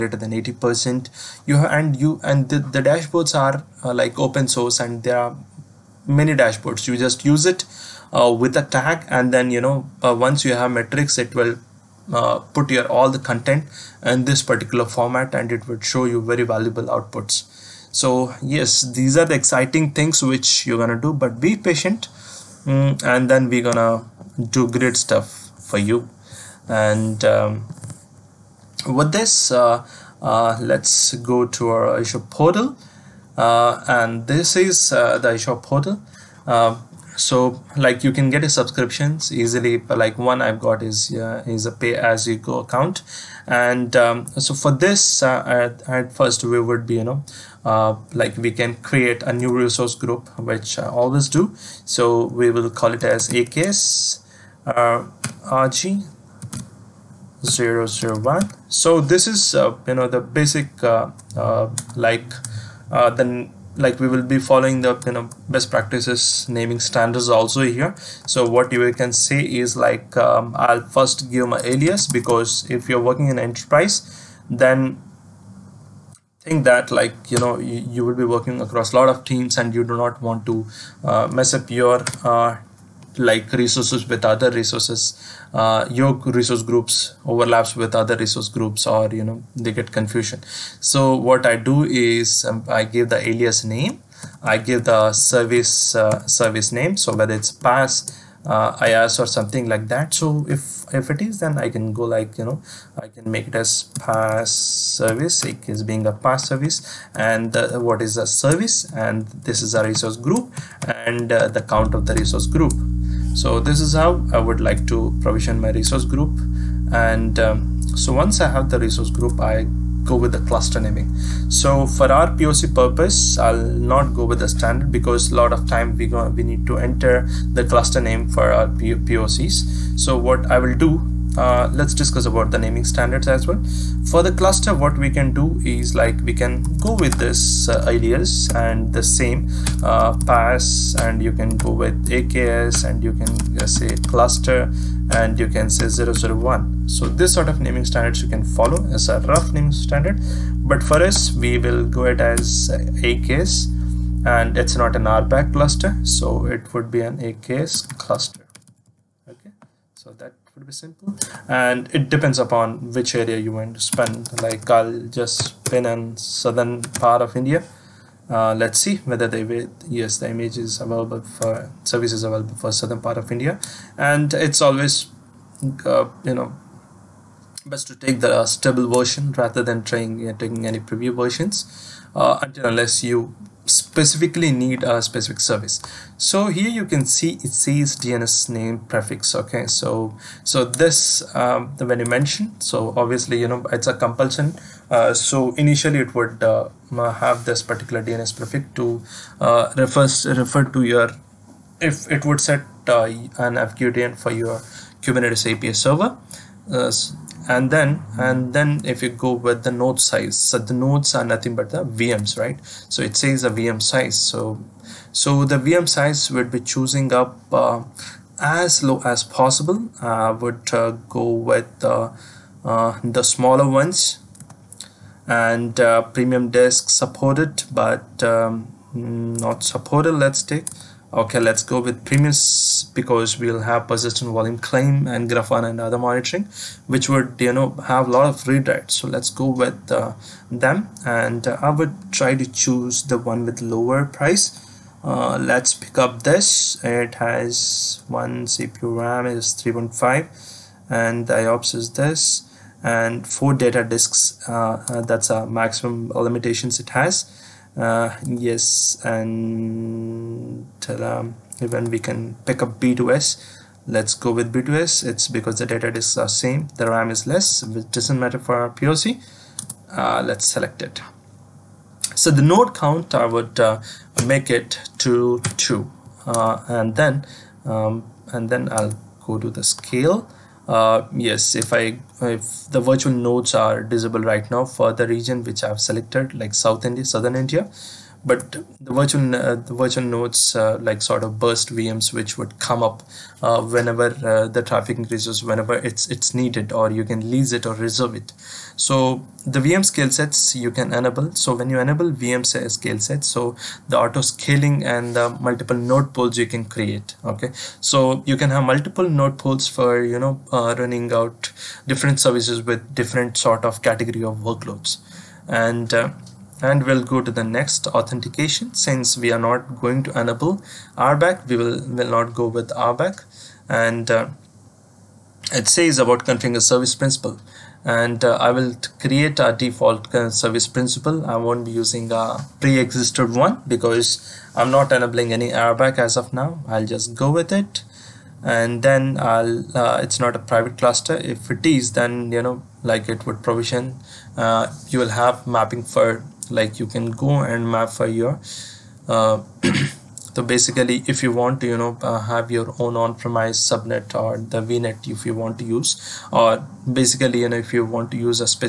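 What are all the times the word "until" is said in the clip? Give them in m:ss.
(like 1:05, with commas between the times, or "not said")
3:02.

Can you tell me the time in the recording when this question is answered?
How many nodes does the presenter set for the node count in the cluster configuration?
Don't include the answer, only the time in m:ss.
4:35.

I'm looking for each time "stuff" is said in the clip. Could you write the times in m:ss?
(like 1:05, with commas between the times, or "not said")
0:24.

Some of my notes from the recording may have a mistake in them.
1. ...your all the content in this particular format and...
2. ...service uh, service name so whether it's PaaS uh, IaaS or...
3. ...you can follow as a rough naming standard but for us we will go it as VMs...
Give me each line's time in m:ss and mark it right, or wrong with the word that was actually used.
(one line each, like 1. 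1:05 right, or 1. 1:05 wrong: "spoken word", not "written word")
1. 0:12 right
2. 1:35 right
3. 2:28 wrong: "AKS", not "VMs".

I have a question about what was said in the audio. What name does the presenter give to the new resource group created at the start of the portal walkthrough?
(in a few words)
AKS RG 001.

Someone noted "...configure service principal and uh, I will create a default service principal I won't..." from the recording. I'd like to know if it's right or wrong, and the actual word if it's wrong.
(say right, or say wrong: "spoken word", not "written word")
right.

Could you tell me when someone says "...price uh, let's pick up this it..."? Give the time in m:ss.
4:04.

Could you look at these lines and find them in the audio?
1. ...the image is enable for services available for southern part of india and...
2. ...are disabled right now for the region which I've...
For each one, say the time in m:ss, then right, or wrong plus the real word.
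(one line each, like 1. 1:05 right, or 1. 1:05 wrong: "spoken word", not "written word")
1. 2:50 wrong: "available", not "enable"
2. 4:43 right.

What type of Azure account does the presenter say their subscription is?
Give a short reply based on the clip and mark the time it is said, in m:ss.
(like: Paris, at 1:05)
Pay as you go, at 0:41.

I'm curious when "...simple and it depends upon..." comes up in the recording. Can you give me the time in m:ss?
2:40.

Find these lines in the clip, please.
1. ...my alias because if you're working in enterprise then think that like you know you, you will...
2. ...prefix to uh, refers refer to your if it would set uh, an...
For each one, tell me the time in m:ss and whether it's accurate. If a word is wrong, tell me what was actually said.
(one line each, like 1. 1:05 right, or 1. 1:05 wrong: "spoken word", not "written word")
1. 1:11 right
2. 3:18 right.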